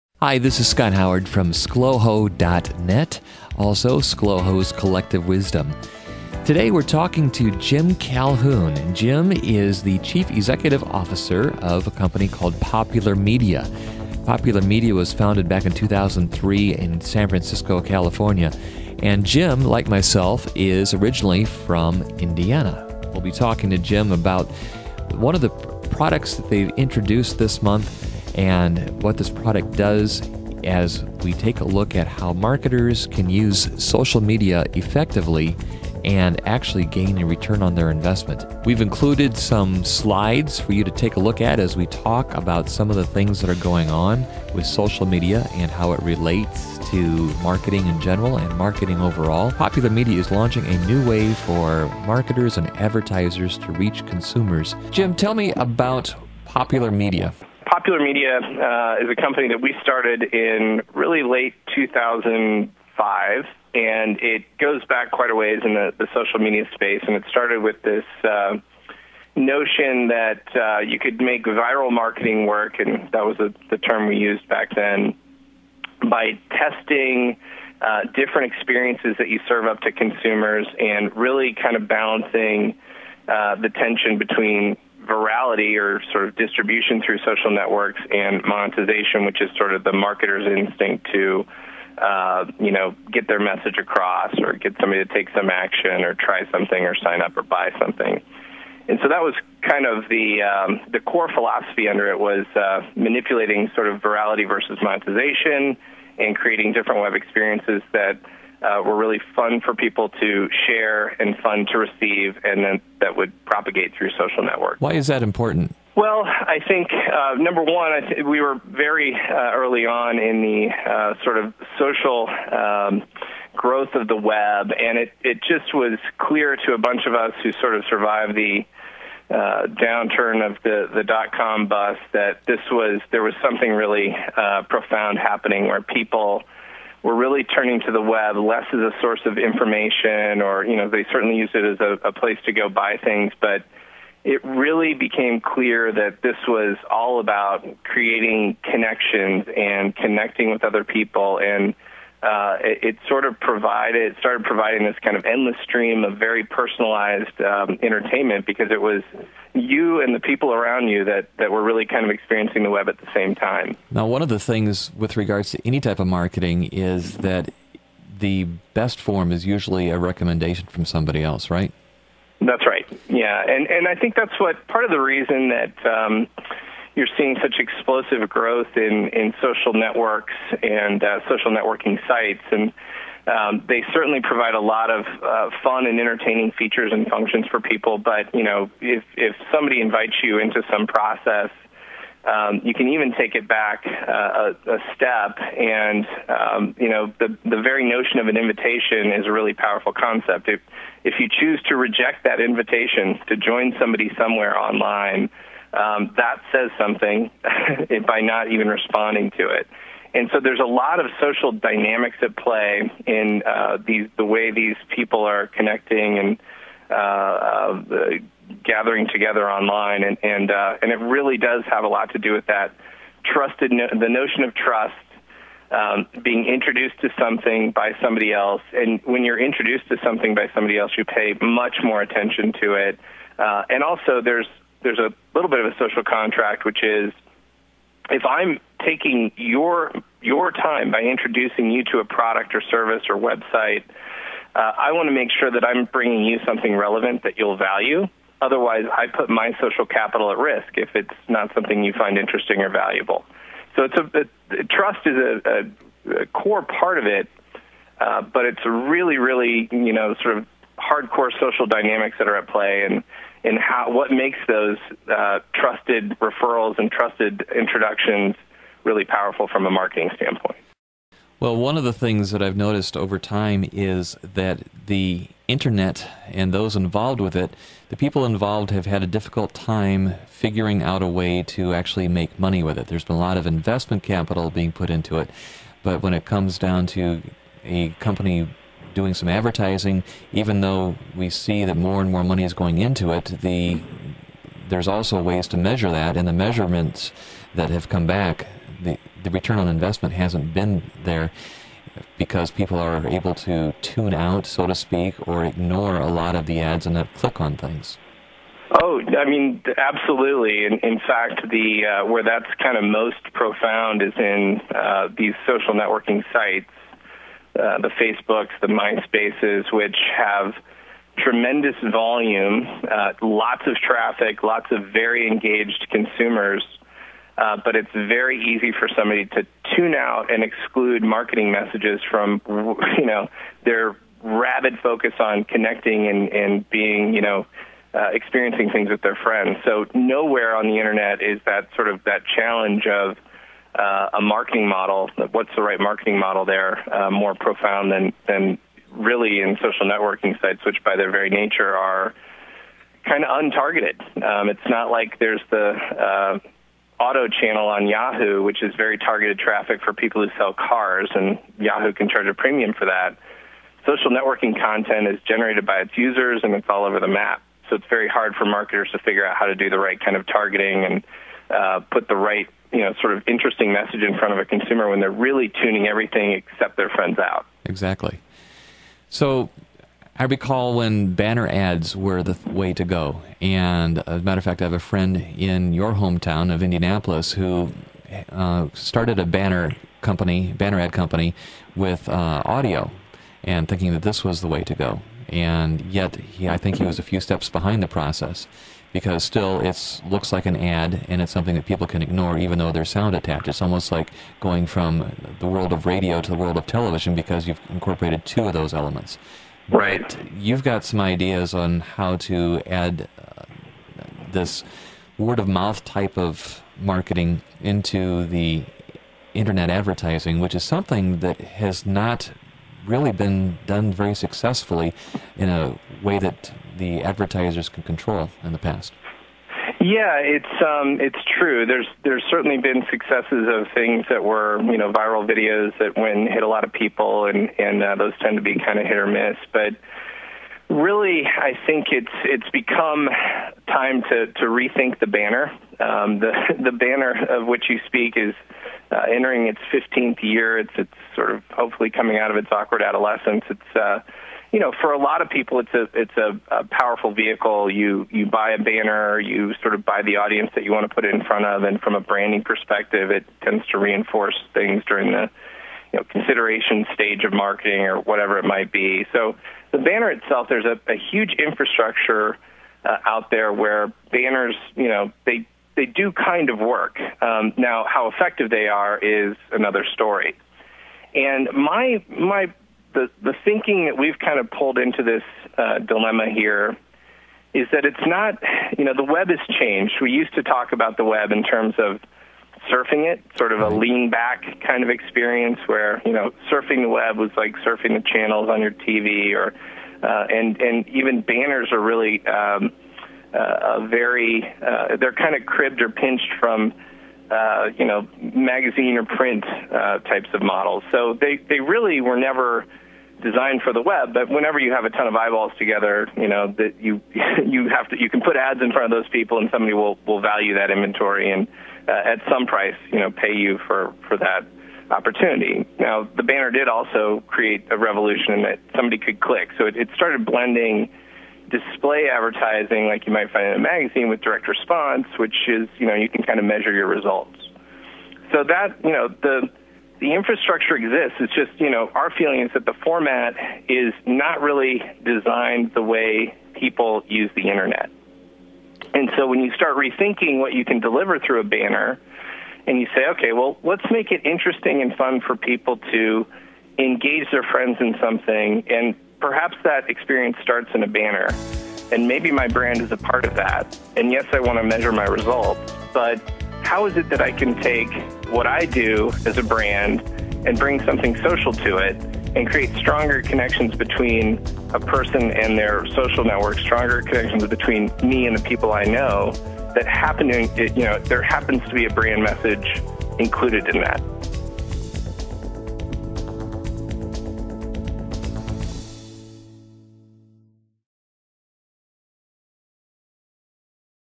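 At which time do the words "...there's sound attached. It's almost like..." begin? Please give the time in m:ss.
6:42.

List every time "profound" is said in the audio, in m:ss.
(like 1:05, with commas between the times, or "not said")
2:14, 5:13, 5:47.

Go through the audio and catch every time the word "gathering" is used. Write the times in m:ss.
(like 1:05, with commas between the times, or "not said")
3:38.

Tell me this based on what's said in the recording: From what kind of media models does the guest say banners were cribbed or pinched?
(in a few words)
magazine or print.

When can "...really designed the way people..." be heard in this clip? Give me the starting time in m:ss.
9:04.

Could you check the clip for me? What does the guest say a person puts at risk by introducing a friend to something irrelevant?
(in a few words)
social capital.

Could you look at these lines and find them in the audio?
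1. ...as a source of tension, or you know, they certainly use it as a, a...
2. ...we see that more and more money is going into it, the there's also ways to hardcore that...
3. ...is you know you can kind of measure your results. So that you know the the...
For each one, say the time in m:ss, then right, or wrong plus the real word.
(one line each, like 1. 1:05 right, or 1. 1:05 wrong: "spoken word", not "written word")
1. 2:18 wrong: "information", not "tension"
2. 4:51 wrong: "measure", not "hardcore"
3. 8:55 right.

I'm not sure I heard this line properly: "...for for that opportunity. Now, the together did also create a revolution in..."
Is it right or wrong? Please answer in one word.
wrong.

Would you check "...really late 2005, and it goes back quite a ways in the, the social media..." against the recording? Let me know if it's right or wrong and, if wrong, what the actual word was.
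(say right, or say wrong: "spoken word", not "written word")
right.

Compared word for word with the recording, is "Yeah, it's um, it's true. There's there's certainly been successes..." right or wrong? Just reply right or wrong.
right.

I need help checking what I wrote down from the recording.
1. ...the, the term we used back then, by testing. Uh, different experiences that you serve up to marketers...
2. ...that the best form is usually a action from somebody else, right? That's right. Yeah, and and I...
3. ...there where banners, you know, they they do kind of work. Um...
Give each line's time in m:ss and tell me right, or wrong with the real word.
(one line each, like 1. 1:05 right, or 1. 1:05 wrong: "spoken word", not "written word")
1. 1:13 wrong: "consumers", not "marketers"
2. 2:47 wrong: "recommendation", not "action"
3. 7:53 right.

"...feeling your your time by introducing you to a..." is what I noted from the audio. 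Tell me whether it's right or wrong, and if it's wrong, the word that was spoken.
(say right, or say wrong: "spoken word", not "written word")
wrong: "taking", not "feeling".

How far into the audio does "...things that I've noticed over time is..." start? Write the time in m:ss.
4:31.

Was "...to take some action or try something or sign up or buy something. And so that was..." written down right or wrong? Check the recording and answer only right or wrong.
right.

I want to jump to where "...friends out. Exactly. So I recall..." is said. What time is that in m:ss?
6:16.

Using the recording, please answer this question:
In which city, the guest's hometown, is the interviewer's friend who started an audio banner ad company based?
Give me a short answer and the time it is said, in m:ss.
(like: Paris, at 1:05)
Indianapolis, at 6:26.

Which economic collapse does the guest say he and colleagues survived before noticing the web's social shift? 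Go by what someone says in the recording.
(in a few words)
dot com bust.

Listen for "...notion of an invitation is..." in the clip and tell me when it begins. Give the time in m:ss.
3:17.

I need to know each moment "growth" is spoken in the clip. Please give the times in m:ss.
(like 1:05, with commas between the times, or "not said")
2:03, 2:58.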